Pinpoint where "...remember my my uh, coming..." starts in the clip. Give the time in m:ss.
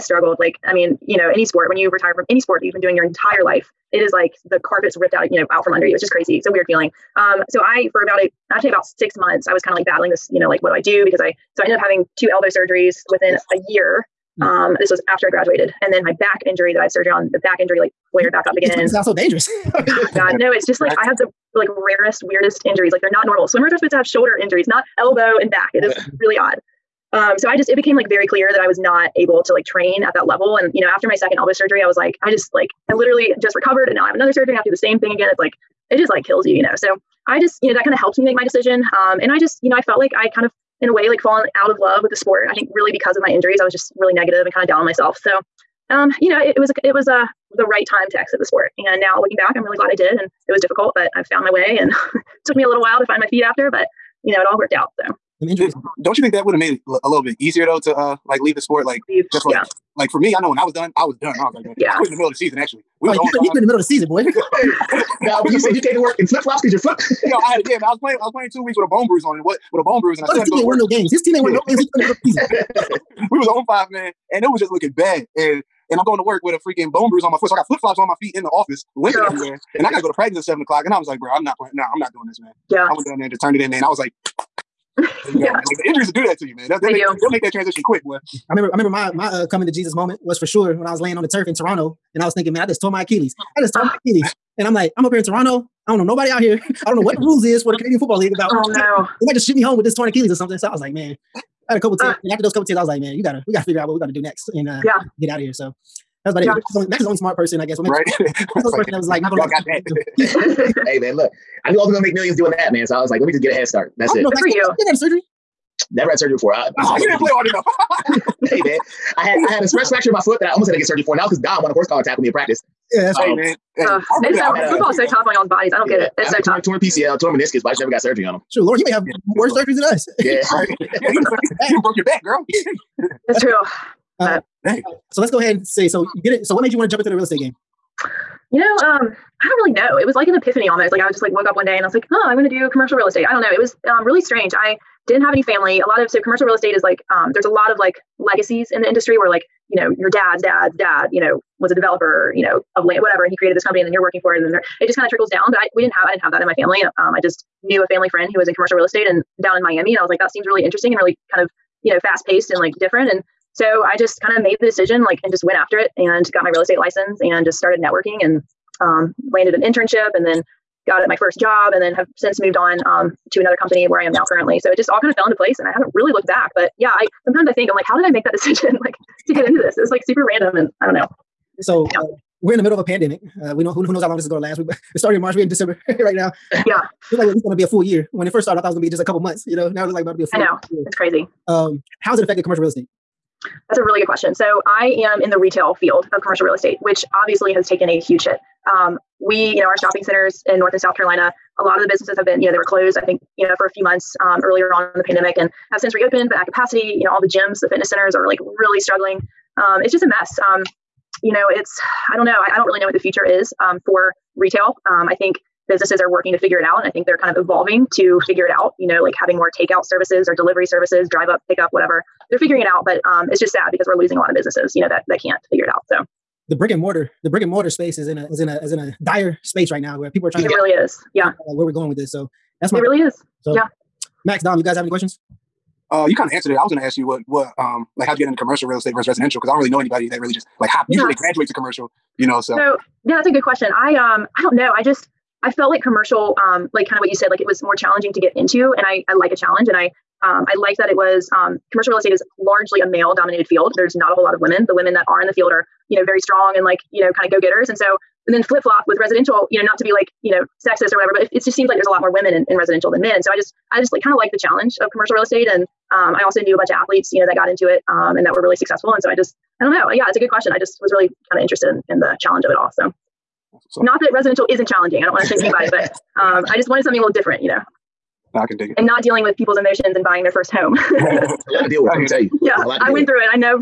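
1:28.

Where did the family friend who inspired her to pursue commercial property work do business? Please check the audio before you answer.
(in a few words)
Miami.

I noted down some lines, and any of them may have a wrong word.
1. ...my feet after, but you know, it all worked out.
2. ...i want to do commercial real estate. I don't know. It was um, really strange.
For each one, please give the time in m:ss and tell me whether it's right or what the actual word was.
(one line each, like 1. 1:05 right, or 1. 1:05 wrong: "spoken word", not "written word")
1. 0:53 right
2. 2:22 right.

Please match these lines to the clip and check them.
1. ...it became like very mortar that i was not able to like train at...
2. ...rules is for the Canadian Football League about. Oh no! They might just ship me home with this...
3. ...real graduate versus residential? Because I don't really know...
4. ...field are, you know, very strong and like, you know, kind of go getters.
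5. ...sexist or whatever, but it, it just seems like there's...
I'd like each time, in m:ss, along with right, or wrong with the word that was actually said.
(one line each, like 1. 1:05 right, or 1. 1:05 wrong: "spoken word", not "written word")
1. 0:27 wrong: "clear", not "mortar"
2. 1:37 right
3. 3:58 wrong: "estate", not "graduate"
4. 4:15 right
5. 4:20 right.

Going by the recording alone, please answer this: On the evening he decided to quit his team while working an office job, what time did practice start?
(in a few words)
7:00.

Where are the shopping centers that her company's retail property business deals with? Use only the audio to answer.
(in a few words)
North and South Carolina.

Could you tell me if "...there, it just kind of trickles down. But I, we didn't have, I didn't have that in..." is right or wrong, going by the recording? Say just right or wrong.
right.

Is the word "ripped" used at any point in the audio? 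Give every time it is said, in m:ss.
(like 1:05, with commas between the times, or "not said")
0:04.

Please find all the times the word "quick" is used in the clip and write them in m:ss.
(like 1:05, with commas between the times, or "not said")
1:27.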